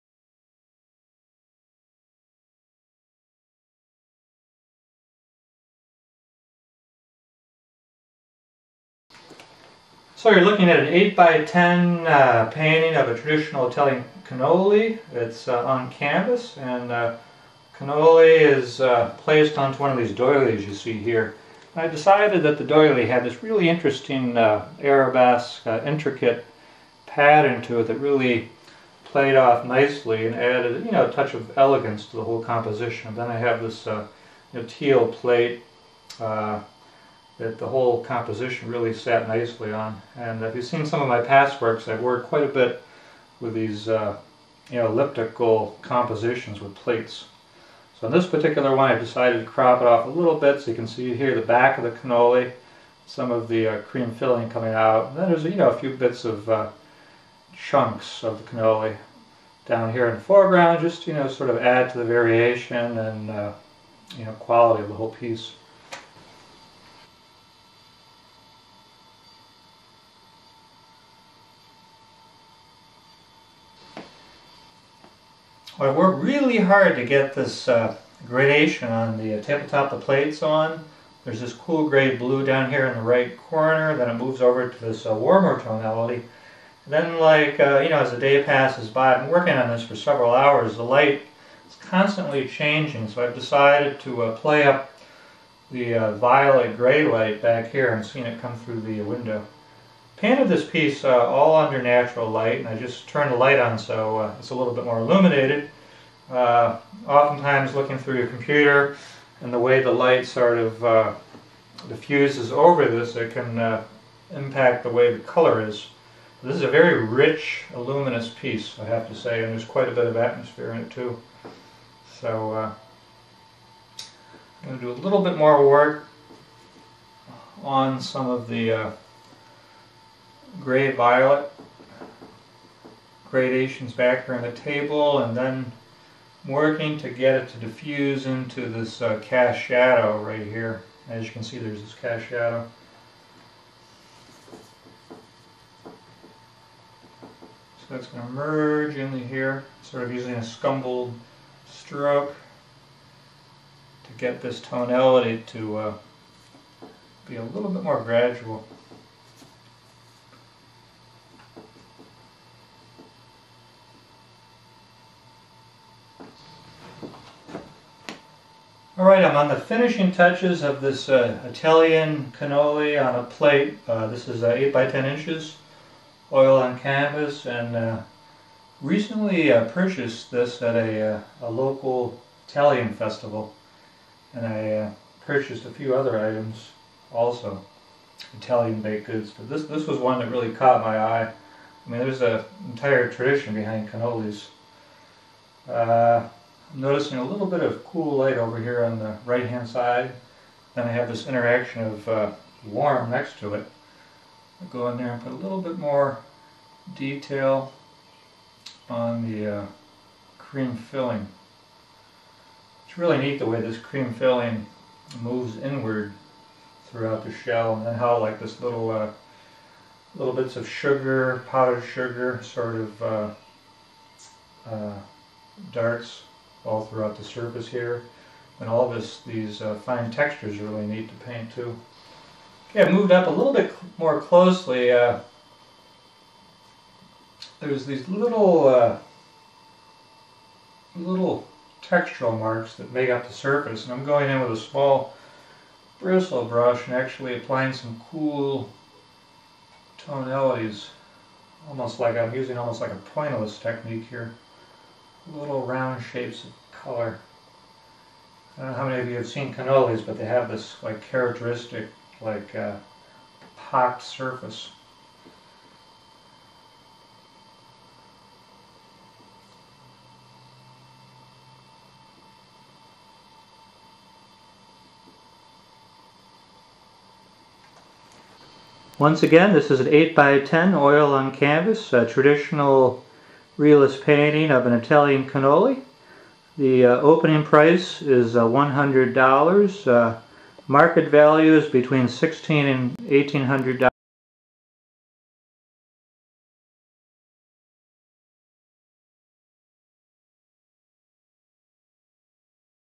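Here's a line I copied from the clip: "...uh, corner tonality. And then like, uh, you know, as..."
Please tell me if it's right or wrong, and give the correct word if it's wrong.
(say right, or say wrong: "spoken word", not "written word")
wrong: "warmer", not "corner".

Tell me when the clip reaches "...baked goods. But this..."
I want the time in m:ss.
3:08.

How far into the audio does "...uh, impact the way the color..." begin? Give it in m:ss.
1:53.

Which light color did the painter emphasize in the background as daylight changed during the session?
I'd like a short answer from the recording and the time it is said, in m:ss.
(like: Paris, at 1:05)
violet gray, at 1:36.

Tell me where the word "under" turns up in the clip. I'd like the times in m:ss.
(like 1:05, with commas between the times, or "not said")
1:41.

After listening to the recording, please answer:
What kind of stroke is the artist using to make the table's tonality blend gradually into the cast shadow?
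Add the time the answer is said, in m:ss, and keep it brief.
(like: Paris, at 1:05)
scumbled, at 2:30.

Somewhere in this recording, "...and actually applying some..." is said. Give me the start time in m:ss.
4:06.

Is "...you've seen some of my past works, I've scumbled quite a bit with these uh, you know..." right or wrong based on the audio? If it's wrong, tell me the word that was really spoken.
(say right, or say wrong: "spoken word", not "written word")
wrong: "worked", not "scumbled".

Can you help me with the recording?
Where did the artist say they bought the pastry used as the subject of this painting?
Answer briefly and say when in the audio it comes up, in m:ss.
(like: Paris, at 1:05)
a local Italian festival, at 3:01.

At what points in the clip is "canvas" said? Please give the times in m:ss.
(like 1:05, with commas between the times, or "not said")
0:15, 2:56, 4:41.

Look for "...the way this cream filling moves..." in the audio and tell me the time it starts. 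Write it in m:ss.
3:33.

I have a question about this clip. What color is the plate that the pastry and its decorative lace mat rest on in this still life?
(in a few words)
teal.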